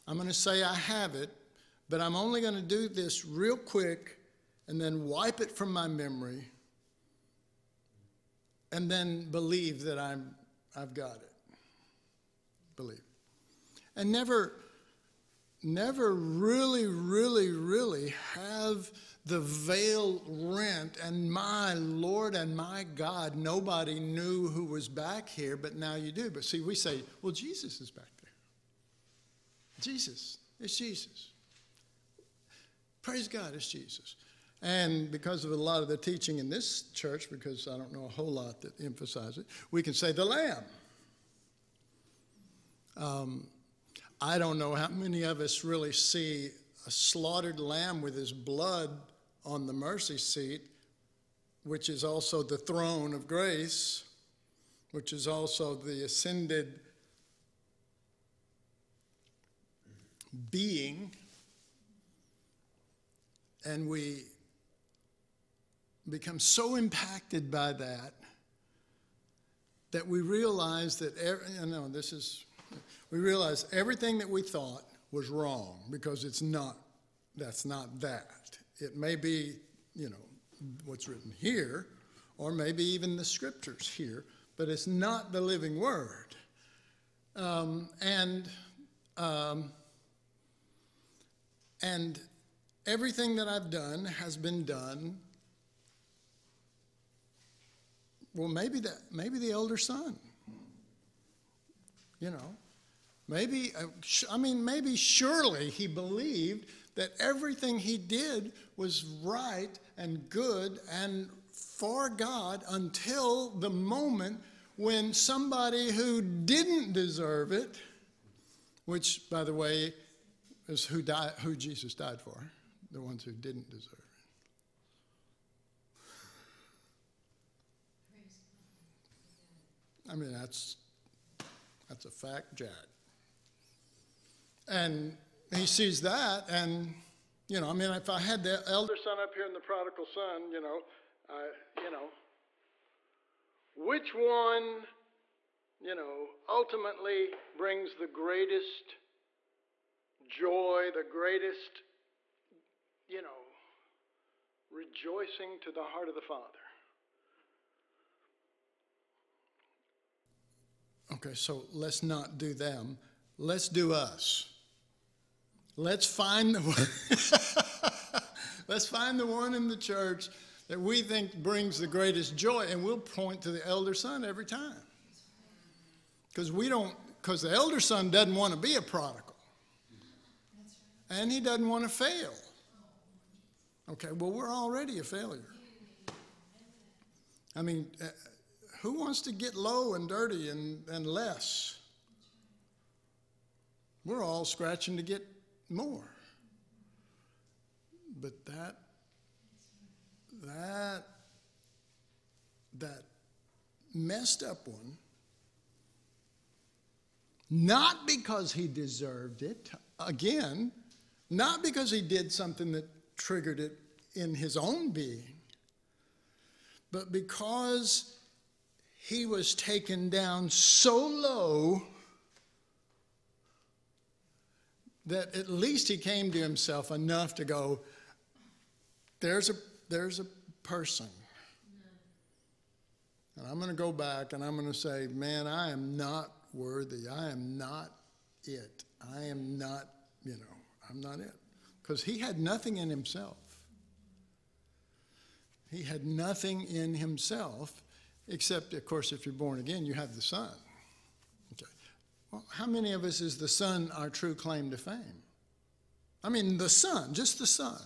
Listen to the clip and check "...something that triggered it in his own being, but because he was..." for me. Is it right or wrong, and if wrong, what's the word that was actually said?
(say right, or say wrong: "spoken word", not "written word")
right.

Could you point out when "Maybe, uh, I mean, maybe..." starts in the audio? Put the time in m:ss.
1:43.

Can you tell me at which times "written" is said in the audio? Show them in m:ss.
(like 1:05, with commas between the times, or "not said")
1:21.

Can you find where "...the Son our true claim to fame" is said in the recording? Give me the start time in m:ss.
4:13.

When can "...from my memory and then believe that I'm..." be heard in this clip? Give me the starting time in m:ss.
0:05.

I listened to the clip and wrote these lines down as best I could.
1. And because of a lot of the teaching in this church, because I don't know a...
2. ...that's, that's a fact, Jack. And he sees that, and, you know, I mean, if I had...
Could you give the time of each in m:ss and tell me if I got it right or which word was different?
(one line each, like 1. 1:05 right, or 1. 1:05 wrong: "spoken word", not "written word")
1. 0:34 right
2. 2:10 right.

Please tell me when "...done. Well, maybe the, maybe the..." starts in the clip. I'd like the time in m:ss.
1:34.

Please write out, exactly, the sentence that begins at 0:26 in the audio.
But see, we say, well, Jesus is back Jesus.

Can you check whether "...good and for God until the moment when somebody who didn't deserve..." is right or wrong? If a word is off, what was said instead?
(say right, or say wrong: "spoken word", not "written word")
right.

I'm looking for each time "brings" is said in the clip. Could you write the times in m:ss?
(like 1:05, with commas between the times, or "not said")
2:27, 2:51.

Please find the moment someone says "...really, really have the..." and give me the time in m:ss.
0:16.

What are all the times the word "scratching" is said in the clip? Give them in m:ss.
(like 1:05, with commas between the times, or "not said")
3:14.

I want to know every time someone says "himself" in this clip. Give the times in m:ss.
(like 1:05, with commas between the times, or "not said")
3:46, 4:02, 4:06.